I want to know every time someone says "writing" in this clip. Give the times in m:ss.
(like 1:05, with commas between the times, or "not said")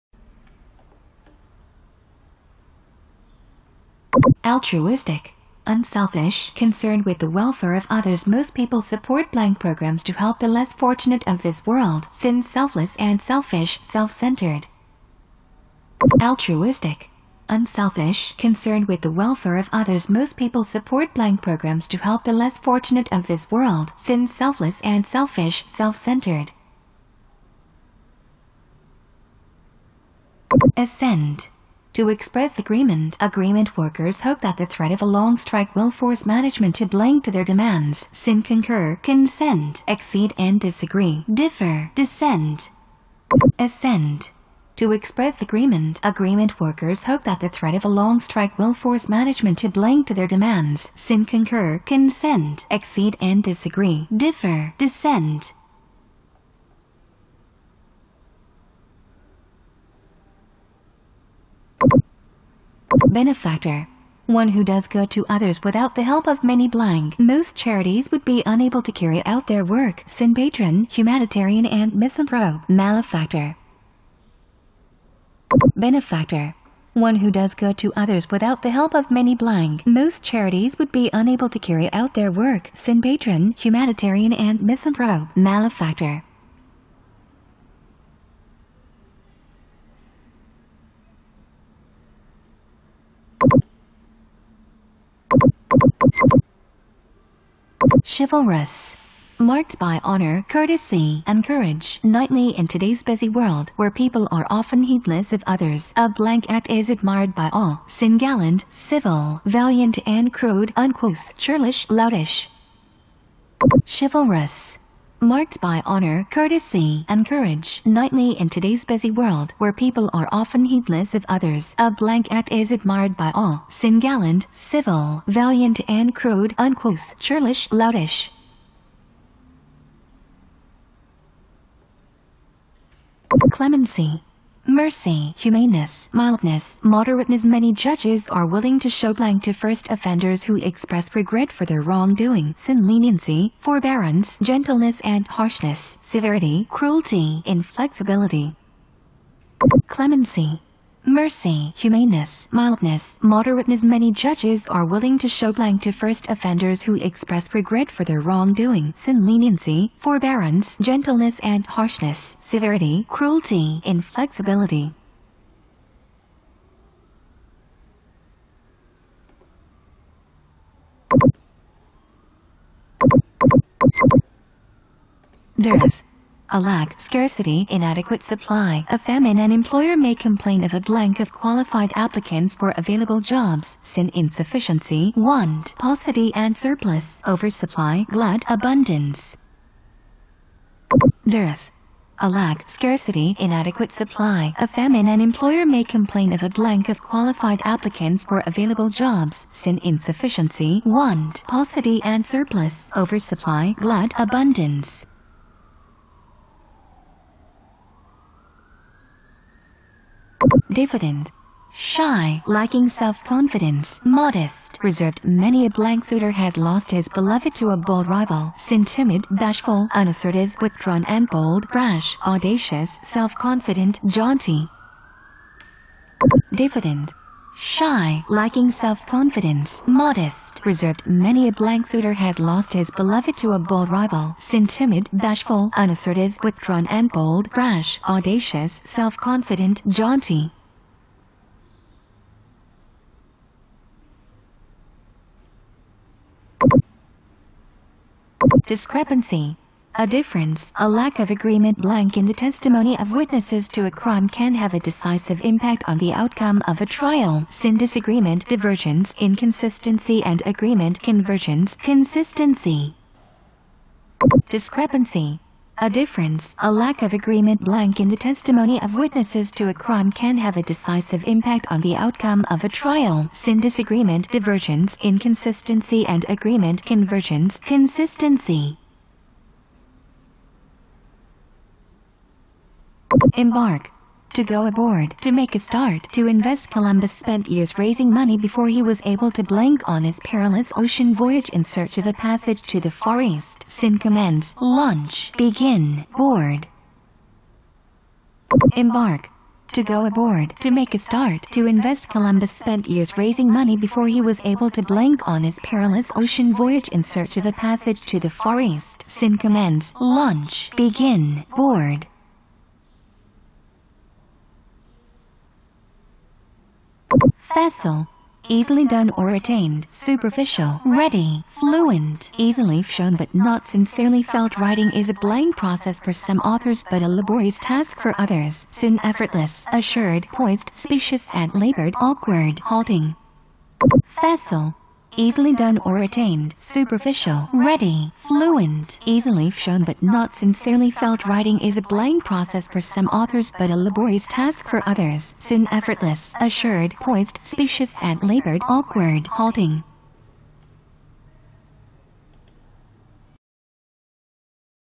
5:24, 5:41.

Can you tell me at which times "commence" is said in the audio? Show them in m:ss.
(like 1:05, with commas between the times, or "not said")
4:53, 5:09.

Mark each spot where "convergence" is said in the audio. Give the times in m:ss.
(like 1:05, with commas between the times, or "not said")
4:21, 4:36.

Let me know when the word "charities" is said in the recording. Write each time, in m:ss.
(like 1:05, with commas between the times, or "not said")
1:07, 1:20.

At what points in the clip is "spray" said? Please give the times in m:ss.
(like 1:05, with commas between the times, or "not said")
not said.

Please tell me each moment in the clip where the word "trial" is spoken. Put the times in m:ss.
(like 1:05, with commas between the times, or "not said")
4:16, 4:32.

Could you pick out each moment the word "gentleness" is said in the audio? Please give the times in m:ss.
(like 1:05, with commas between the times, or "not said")
2:24, 2:40.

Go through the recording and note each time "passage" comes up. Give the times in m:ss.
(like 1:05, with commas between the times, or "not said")
4:52, 5:07.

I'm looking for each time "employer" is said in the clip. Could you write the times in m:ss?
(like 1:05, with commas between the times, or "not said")
2:59, 3:15.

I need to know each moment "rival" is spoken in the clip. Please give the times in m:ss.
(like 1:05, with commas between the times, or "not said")
3:38, 3:53.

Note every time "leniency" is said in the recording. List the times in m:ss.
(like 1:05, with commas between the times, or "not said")
2:22, 2:39.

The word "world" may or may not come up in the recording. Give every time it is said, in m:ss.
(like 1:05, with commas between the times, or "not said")
0:11, 0:23, 1:43, 1:59.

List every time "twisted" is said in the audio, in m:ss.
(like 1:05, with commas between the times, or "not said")
not said.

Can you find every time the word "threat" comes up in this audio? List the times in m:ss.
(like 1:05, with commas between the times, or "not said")
0:34, 0:47.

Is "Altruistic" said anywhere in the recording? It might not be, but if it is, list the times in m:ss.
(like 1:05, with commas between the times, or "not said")
0:04, 0:16.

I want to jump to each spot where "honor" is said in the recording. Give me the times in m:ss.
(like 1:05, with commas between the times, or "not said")
1:40, 1:55.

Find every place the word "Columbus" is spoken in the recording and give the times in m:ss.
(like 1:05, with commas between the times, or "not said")
4:46, 5:02.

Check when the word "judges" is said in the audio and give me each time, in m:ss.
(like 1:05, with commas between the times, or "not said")
2:17, 2:34.